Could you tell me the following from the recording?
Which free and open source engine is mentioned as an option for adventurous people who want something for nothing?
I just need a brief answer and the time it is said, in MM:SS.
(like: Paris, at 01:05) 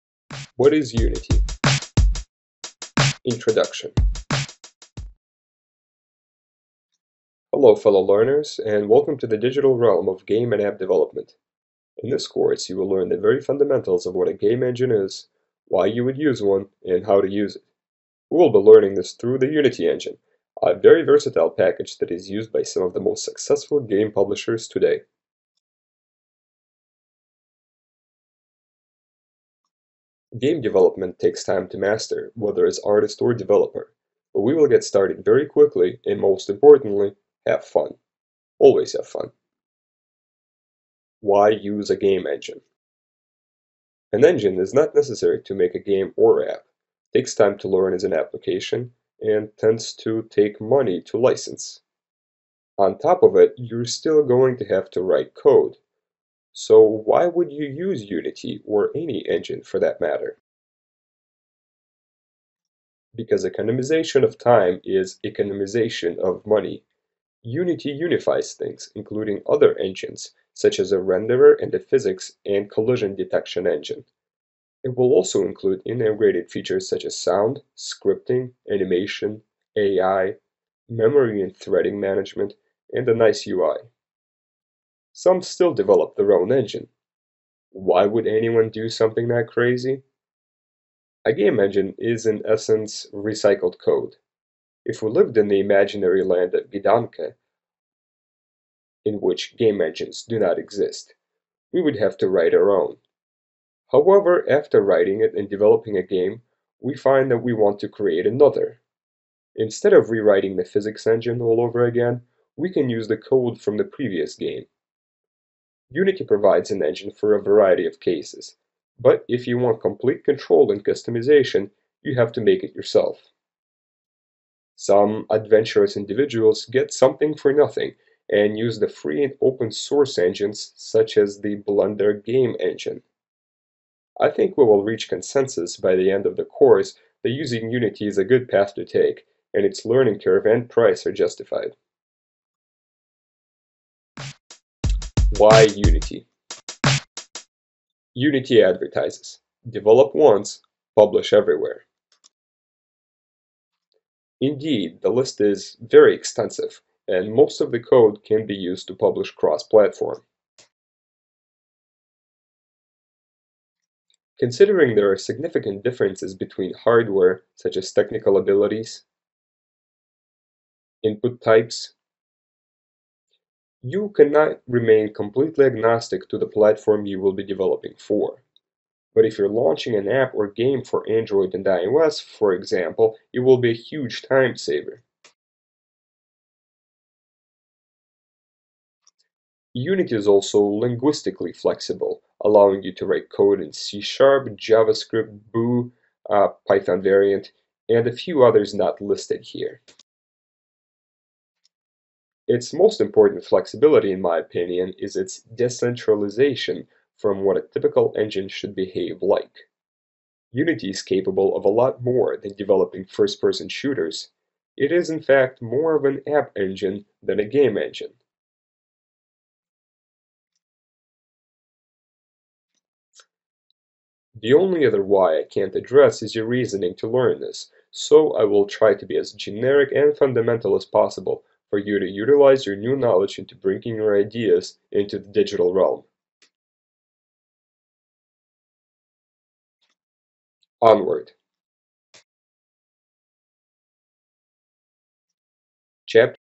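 Blender Game Engine, at 02:11.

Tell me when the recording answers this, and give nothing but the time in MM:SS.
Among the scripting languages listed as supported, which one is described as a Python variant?
03:15.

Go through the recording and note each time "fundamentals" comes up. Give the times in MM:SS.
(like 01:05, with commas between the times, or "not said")
00:13, 03:50.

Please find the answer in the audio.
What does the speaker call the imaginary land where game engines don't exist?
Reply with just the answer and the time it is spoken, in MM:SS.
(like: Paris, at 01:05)
Gidanka, at 01:36.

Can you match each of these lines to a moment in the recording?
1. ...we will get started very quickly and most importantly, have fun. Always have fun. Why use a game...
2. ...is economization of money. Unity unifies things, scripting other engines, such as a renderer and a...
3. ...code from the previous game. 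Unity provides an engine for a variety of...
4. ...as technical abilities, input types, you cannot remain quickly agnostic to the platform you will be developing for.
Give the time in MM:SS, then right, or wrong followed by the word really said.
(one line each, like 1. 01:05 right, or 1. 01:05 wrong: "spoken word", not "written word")
1. 00:34 right
2. 01:04 wrong: "including", not "scripting"
3. 01:53 right
4. 02:47 wrong: "completely", not "quickly".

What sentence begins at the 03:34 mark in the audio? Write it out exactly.
It is, in fact, more of an app engine than a game engine.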